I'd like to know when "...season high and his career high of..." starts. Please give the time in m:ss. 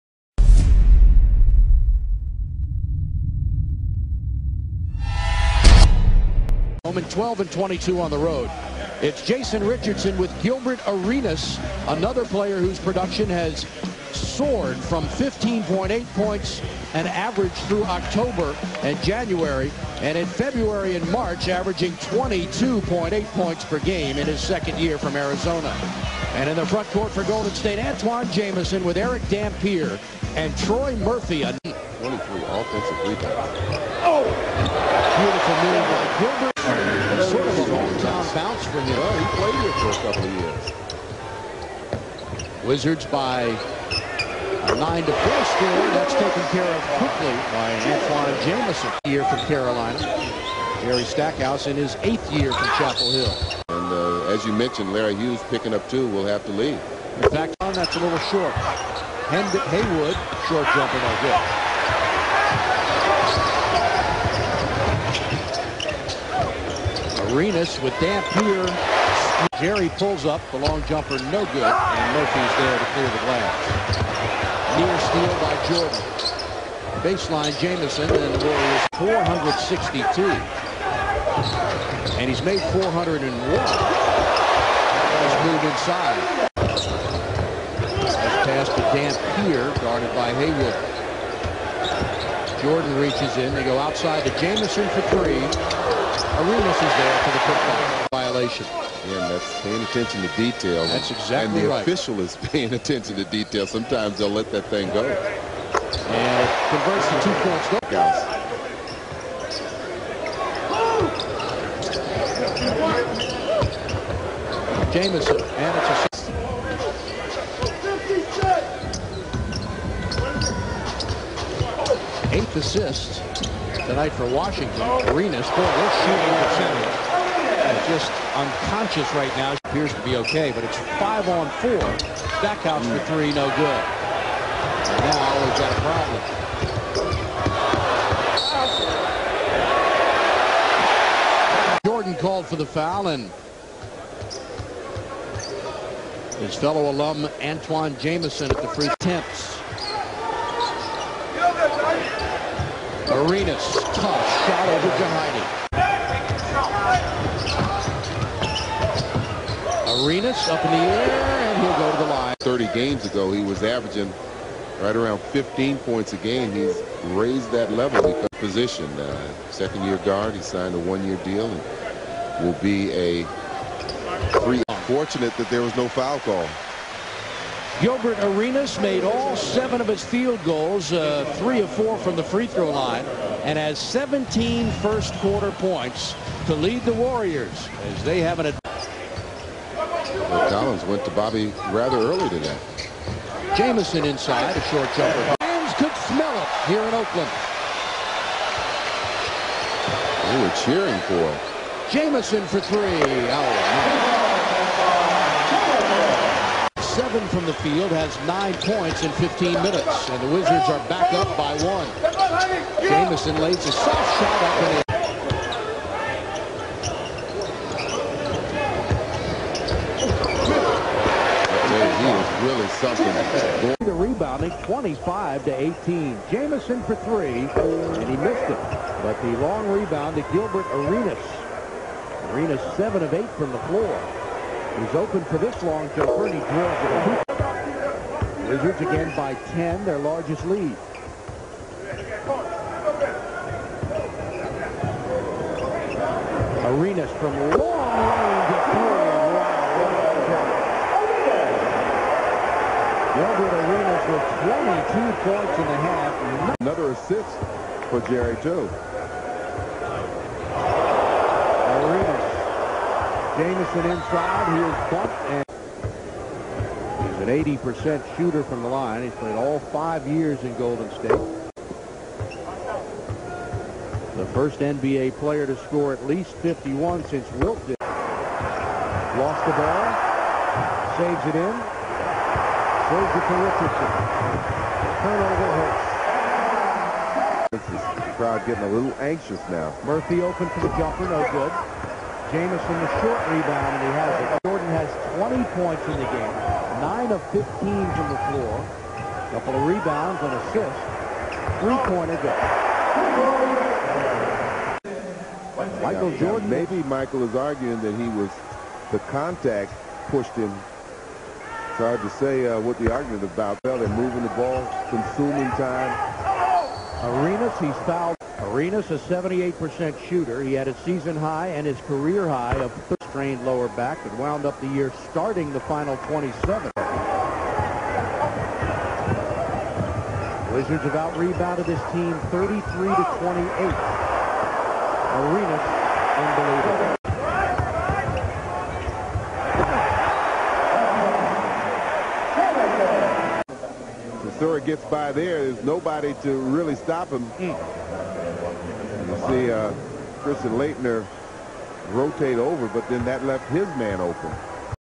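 5:20.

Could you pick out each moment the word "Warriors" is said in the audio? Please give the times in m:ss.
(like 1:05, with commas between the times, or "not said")
1:18, 3:06.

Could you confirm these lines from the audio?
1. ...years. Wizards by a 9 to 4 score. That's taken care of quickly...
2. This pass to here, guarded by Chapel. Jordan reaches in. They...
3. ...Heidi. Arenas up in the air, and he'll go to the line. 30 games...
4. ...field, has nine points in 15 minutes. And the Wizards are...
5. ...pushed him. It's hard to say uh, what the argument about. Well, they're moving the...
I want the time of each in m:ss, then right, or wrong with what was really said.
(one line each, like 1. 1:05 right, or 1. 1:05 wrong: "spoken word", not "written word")
1. 0:42 right
2. 1:28 wrong: "Haywood", not "Chapel"
3. 2:35 right
4. 3:27 right
5. 5:10 right.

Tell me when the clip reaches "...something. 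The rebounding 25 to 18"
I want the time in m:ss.
3:42.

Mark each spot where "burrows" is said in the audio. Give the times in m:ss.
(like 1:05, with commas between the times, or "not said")
not said.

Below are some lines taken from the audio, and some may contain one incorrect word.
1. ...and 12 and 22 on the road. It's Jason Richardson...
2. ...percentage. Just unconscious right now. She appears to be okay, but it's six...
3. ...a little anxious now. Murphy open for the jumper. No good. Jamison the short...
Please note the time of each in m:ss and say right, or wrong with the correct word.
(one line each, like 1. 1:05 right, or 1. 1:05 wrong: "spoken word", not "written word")
1. 0:07 right
2. 2:06 wrong: "five", not "six"
3. 4:48 right.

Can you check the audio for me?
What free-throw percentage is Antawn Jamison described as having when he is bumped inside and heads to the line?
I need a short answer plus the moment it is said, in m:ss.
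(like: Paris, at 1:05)
80%, at 4:27.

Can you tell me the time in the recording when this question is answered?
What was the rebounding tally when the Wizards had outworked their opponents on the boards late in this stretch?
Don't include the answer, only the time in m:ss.
5:32.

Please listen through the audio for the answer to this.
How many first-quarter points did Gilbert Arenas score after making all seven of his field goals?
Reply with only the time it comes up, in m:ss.
3:03.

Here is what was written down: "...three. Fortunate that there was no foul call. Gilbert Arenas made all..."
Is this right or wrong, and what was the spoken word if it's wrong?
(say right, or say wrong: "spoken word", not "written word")
right.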